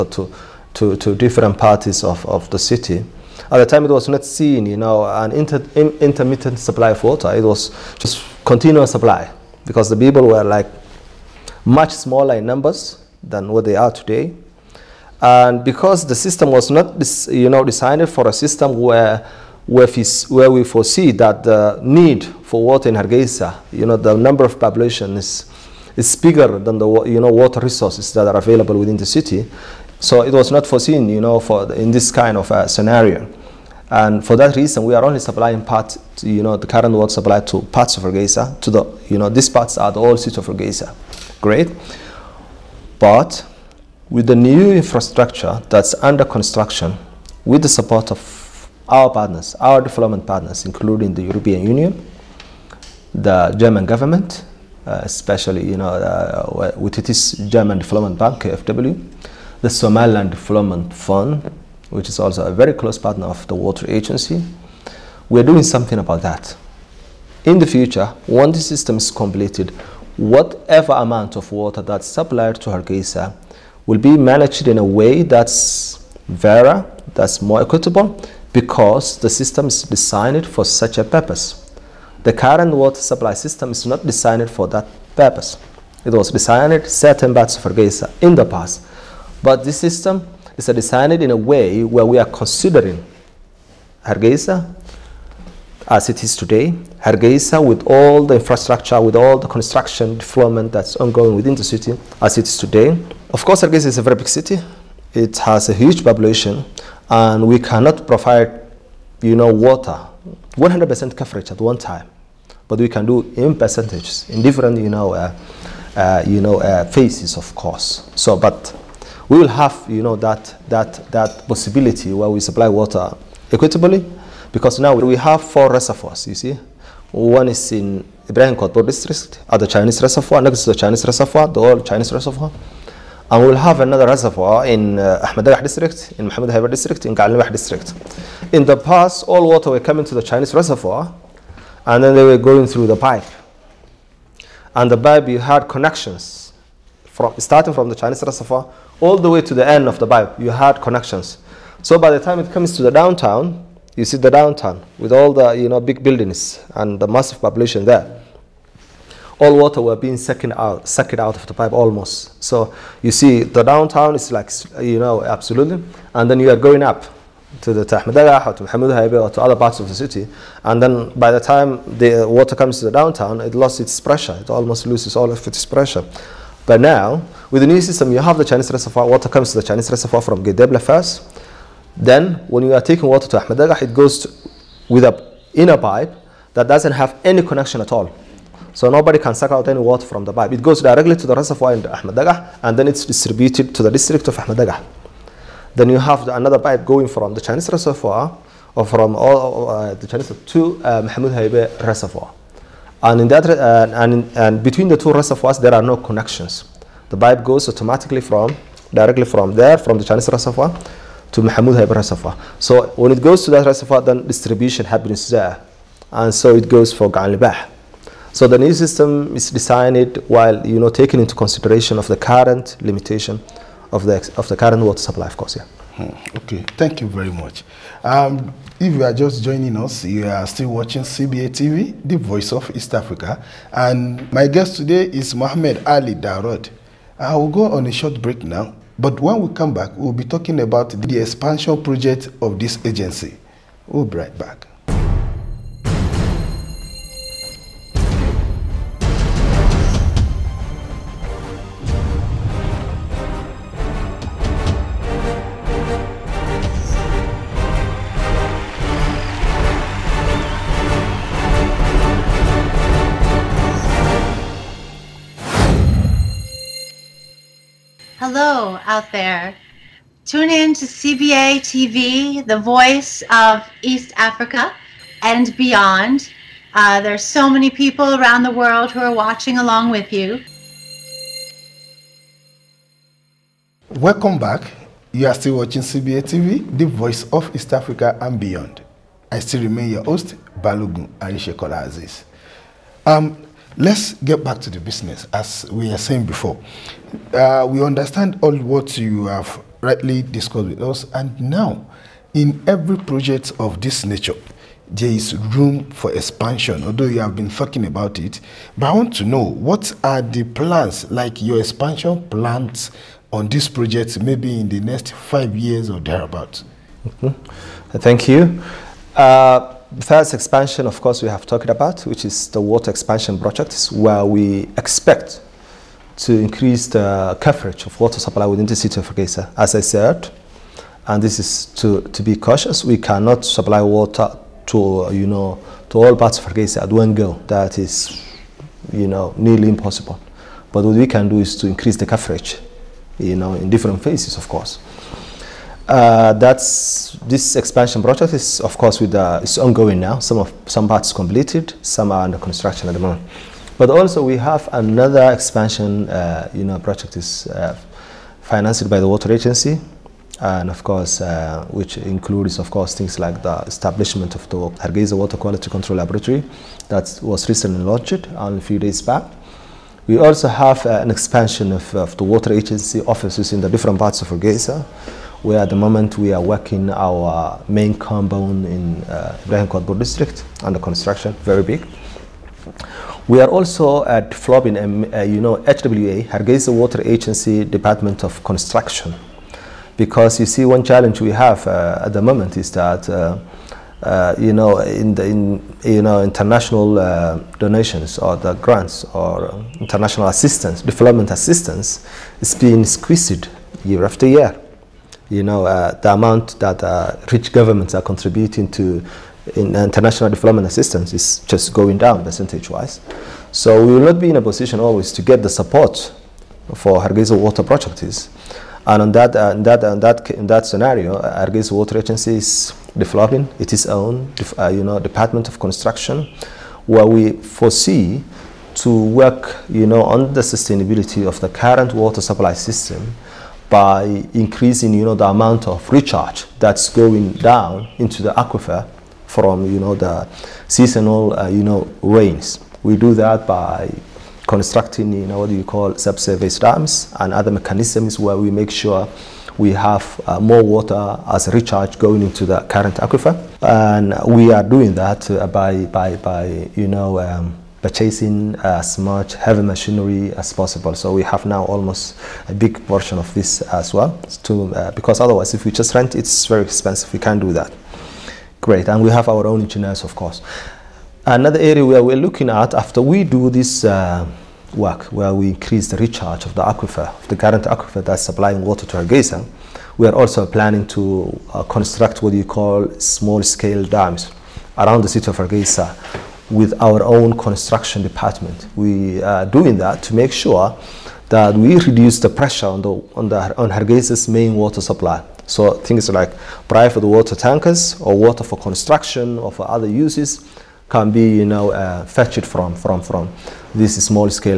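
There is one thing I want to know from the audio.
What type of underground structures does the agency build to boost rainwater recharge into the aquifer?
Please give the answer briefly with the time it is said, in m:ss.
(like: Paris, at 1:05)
subsurface dams, at 7:25.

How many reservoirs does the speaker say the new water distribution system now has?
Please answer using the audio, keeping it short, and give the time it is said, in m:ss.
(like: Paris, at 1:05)
4, at 2:05.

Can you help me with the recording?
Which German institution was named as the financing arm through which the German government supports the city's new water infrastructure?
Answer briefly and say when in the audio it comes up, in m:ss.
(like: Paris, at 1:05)
German Development Bank, at 0:57.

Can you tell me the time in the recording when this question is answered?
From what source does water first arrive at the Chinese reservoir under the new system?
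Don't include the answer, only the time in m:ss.
3:00.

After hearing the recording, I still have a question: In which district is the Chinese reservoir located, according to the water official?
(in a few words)
Ibrahim Kotor.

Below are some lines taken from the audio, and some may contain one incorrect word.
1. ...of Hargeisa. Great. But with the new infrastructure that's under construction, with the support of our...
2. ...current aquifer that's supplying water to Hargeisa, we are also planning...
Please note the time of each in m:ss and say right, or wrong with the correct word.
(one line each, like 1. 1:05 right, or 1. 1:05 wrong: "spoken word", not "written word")
1. 0:40 right
2. 7:57 right.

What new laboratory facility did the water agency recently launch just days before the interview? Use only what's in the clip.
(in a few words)
Hargeisa Water Quality Control Laboratory.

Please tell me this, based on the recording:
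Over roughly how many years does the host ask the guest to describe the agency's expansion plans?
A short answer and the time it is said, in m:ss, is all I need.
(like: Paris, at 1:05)
5, at 5:15.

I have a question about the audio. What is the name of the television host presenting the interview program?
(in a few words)
Balogun Arishekola Aziz.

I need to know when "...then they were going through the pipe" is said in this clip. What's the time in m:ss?
2:22.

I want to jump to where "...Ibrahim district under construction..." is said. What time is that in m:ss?
6:19.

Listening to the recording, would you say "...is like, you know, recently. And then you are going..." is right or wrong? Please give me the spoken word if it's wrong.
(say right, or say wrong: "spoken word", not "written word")
wrong: "absolutely", not "recently".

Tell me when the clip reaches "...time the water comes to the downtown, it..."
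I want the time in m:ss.
2:51.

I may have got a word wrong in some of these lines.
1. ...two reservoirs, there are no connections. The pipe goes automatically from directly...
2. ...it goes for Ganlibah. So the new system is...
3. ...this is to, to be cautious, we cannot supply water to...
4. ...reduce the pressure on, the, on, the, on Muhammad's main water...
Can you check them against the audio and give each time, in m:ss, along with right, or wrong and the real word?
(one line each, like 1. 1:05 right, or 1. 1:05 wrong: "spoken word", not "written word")
1. 3:24 right
2. 3:36 right
3. 5:31 right
4. 8:11 wrong: "Hargeisa", not "Muhammad".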